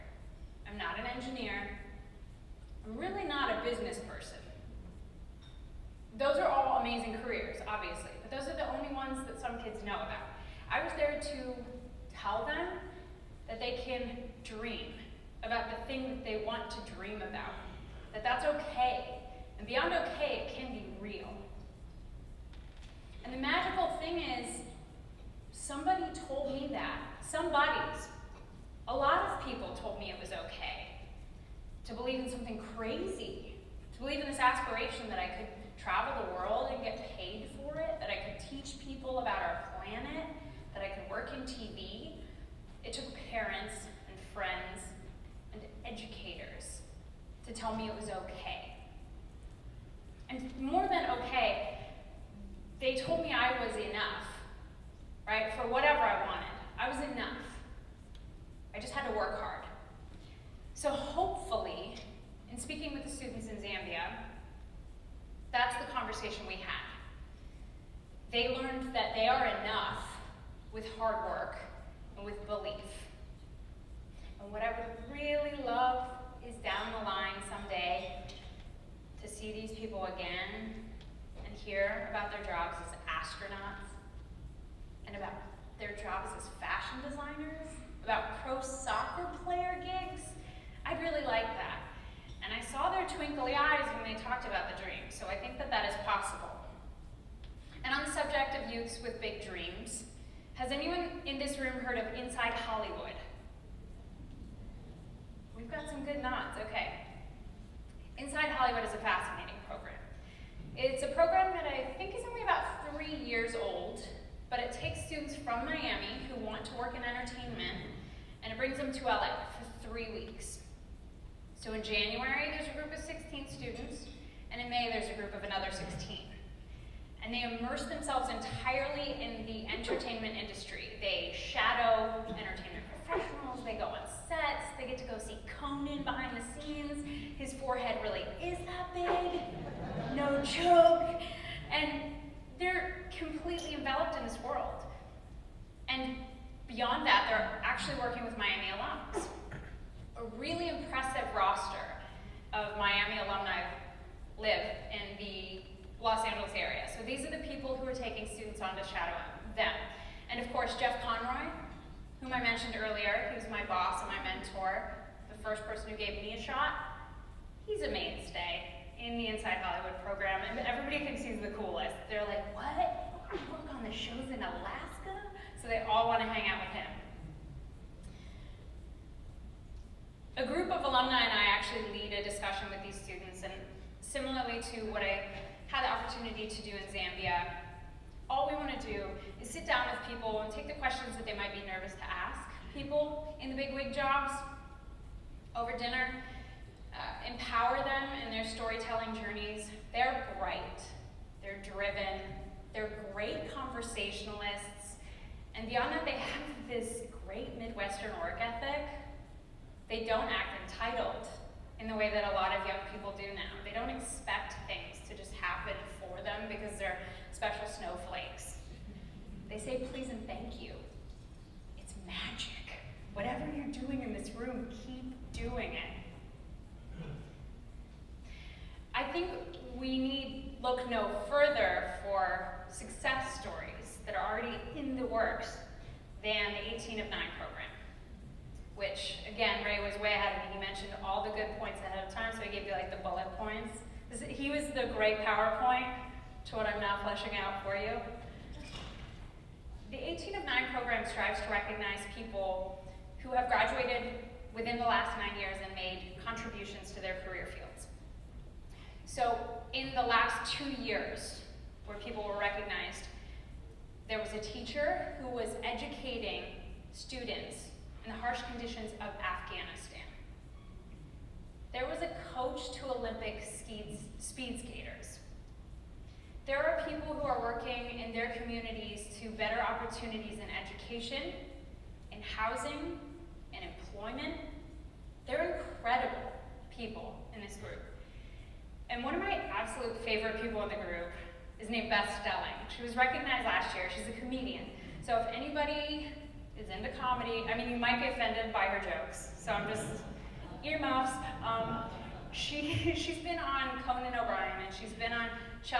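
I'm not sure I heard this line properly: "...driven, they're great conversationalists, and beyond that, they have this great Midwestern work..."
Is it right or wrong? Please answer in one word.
right.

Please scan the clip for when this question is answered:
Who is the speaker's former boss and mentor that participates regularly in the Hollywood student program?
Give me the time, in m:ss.
2:40.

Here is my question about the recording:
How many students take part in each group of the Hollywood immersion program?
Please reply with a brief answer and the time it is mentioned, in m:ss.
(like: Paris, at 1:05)
16, at 2:03.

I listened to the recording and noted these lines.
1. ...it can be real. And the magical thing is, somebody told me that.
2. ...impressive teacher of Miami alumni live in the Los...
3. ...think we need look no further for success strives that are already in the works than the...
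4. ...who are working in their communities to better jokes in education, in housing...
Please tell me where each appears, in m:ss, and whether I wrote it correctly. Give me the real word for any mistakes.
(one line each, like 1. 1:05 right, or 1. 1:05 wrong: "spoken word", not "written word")
1. 0:20 right
2. 2:30 wrong: "roster", not "teacher"
3. 3:49 wrong: "stories", not "strives"
4. 4:37 wrong: "opportunities", not "jokes".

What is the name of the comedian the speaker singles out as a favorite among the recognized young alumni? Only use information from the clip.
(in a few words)
Beth Stelling.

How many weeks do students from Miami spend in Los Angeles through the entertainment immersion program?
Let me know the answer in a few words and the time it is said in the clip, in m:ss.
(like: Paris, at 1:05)
3, at 1:59.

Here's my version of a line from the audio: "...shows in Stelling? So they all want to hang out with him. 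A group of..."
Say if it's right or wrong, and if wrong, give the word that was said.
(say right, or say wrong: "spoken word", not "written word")
wrong: "Alaska", not "Stelling".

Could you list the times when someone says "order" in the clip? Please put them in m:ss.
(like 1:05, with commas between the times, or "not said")
not said.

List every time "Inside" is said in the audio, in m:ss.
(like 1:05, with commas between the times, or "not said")
1:42, 1:48, 2:49.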